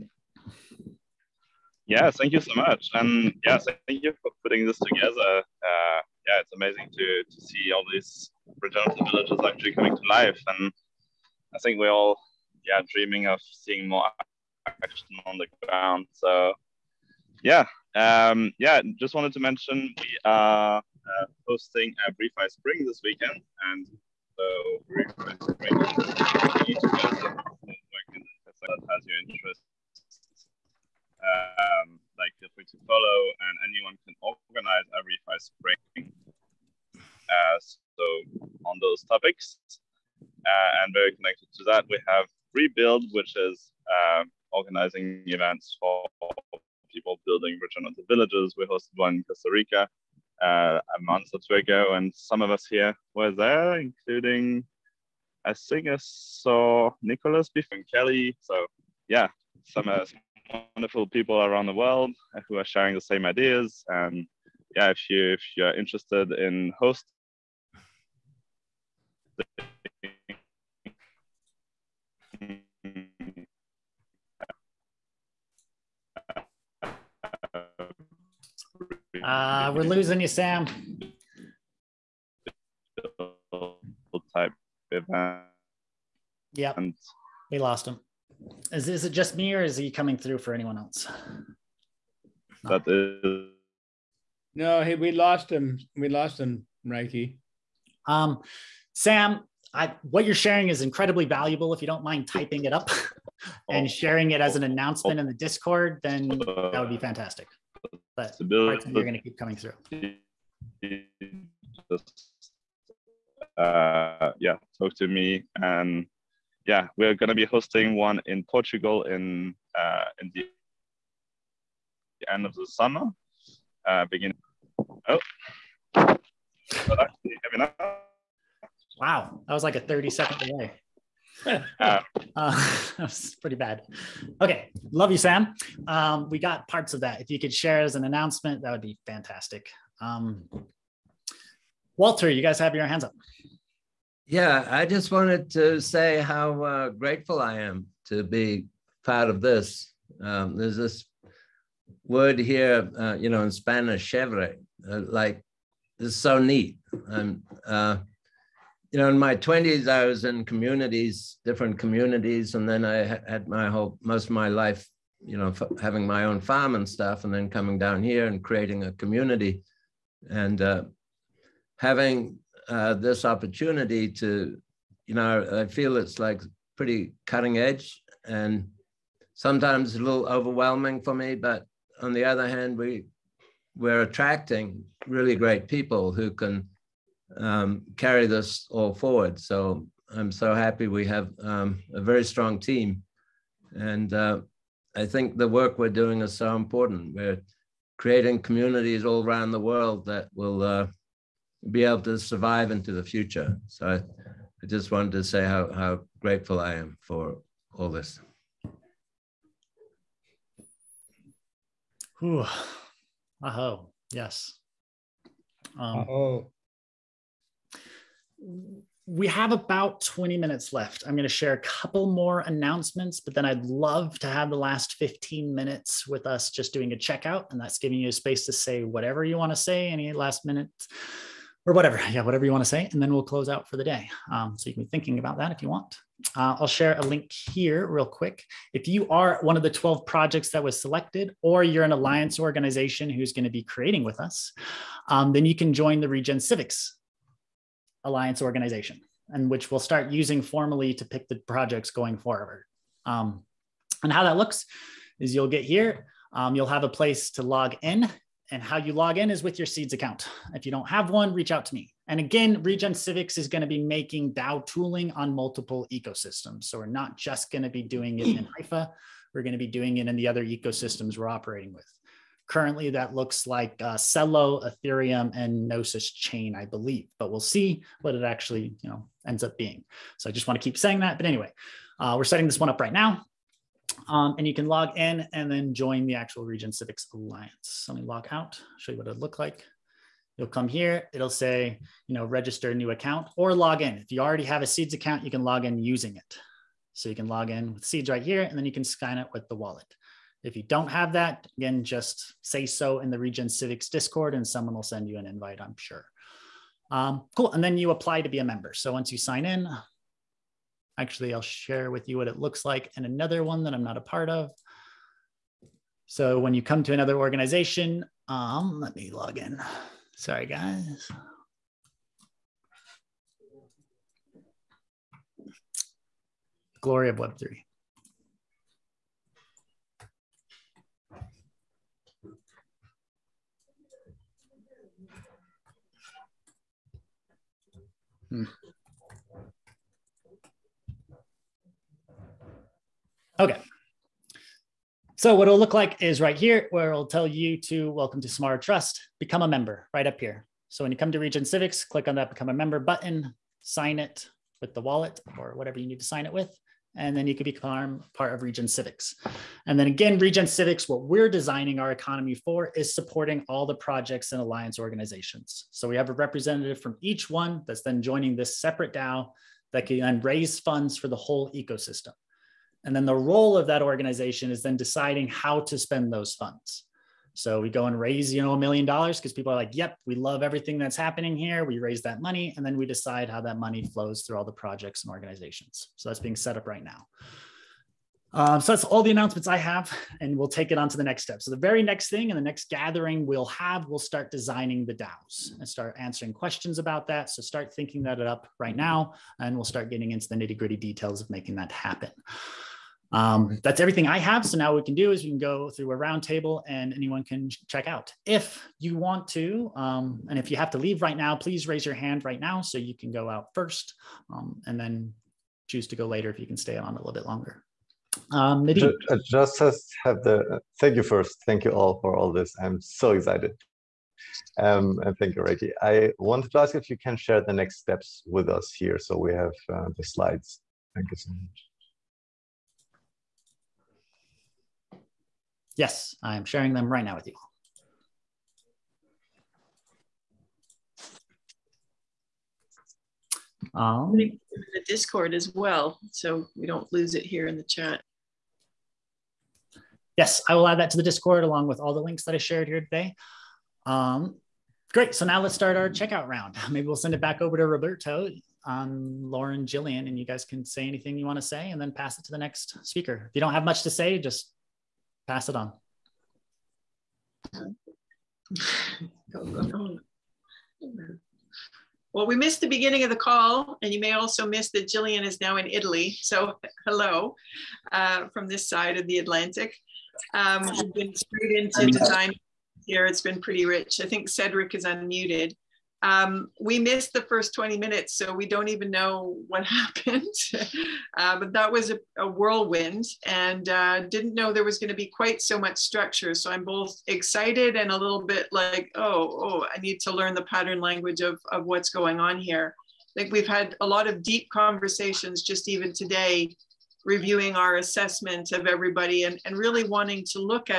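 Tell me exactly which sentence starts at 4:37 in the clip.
But we'll see what it actually you know ends up being.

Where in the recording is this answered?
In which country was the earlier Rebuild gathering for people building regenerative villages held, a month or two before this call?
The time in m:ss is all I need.
0:49.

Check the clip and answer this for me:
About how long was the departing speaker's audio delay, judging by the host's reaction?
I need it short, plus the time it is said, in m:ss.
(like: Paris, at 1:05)
30 seconds, at 2:09.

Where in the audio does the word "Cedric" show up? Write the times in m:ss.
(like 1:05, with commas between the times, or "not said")
8:04.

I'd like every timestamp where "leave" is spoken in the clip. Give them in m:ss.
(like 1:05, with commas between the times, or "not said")
6:50.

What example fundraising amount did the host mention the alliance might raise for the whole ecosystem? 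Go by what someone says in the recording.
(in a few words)
a million dollars.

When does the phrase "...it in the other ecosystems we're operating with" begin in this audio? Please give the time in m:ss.
4:29.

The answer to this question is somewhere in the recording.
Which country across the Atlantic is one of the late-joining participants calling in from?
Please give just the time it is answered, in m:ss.
7:55.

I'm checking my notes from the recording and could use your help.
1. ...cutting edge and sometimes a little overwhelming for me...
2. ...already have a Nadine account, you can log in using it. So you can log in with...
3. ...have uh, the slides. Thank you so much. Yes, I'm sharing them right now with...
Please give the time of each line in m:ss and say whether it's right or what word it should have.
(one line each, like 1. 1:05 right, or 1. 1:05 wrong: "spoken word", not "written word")
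1. 2:57 right
2. 4:54 wrong: "Seeds", not "Nadine"
3. 7:09 right.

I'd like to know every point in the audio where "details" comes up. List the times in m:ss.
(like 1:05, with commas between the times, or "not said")
6:40.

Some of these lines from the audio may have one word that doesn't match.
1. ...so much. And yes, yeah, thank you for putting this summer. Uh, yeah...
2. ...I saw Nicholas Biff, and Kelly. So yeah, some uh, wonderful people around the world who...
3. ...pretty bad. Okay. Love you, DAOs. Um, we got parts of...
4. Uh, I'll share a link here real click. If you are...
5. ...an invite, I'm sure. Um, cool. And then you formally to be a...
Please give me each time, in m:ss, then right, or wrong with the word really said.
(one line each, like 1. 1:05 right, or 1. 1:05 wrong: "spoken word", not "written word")
1. 0:02 wrong: "together", not "summer"
2. 0:55 right
3. 2:13 wrong: "Sam", not "DAOs"
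4. 3:56 wrong: "quick", not "click"
5. 5:05 wrong: "apply", not "formally".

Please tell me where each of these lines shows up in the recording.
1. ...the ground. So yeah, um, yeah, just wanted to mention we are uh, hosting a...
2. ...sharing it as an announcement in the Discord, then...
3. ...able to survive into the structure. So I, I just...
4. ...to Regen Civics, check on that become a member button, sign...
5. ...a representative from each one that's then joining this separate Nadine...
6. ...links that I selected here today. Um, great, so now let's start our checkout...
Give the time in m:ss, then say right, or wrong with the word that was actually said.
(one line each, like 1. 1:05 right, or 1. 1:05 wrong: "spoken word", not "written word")
1. 0:15 right
2. 1:43 right
3. 3:21 wrong: "future", not "structure"
4. 5:51 wrong: "click", not "check"
5. 6:06 wrong: "DAO", not "Nadine"
6. 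7:32 wrong: "shared", not "selected".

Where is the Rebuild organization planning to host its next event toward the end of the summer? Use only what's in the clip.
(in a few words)
Portugal.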